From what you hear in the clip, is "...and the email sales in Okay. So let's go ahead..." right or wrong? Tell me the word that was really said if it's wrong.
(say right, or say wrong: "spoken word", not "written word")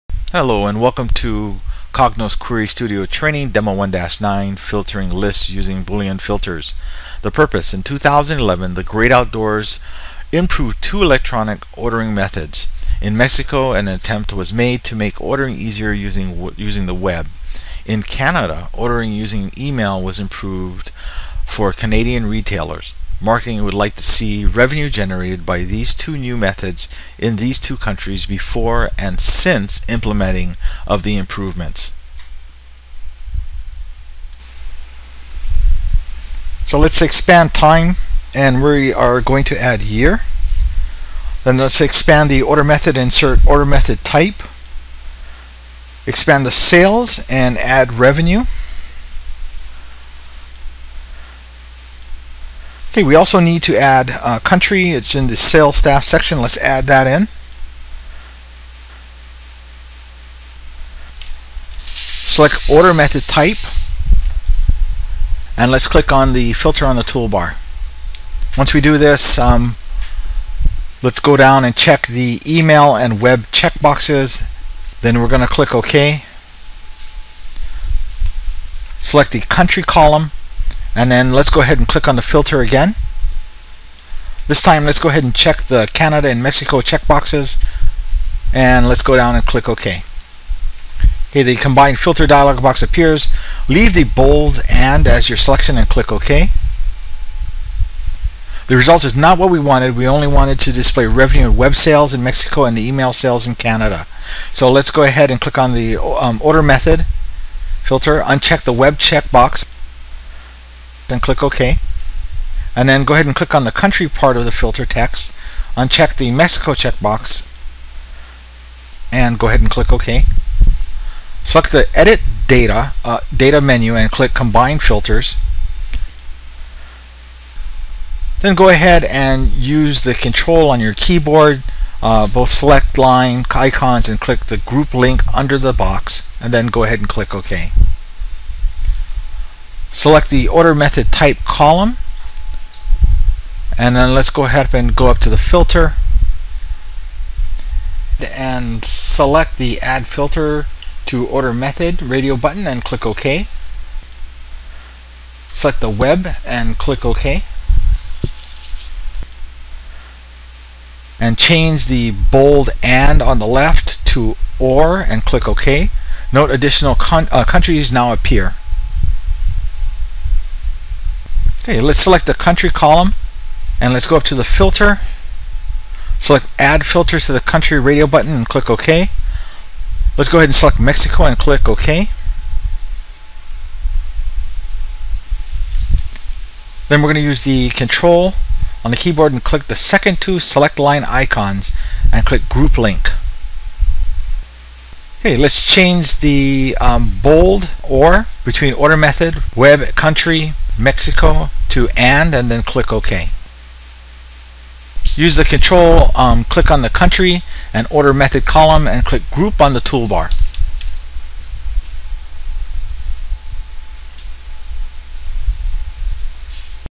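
wrong: "Canada", not "Okay".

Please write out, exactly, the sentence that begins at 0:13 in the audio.
In Mexico an attempt was made to make ordering easier using, using the web.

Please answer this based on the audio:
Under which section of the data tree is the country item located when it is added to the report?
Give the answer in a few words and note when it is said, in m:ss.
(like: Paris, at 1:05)
Sales staff, at 0:55.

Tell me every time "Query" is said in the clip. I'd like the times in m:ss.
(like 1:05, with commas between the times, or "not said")
0:02.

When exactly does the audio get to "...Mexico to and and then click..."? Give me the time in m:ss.
3:20.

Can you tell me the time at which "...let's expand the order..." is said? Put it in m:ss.
0:41.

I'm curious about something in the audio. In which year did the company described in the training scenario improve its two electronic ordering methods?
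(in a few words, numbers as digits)
2011.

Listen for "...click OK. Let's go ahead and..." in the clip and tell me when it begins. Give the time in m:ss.
2:58.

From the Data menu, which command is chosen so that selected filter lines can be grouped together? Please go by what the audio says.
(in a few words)
Combine Filters.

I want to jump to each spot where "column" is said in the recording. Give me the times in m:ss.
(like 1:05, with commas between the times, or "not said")
1:19, 2:21, 2:52, 3:28.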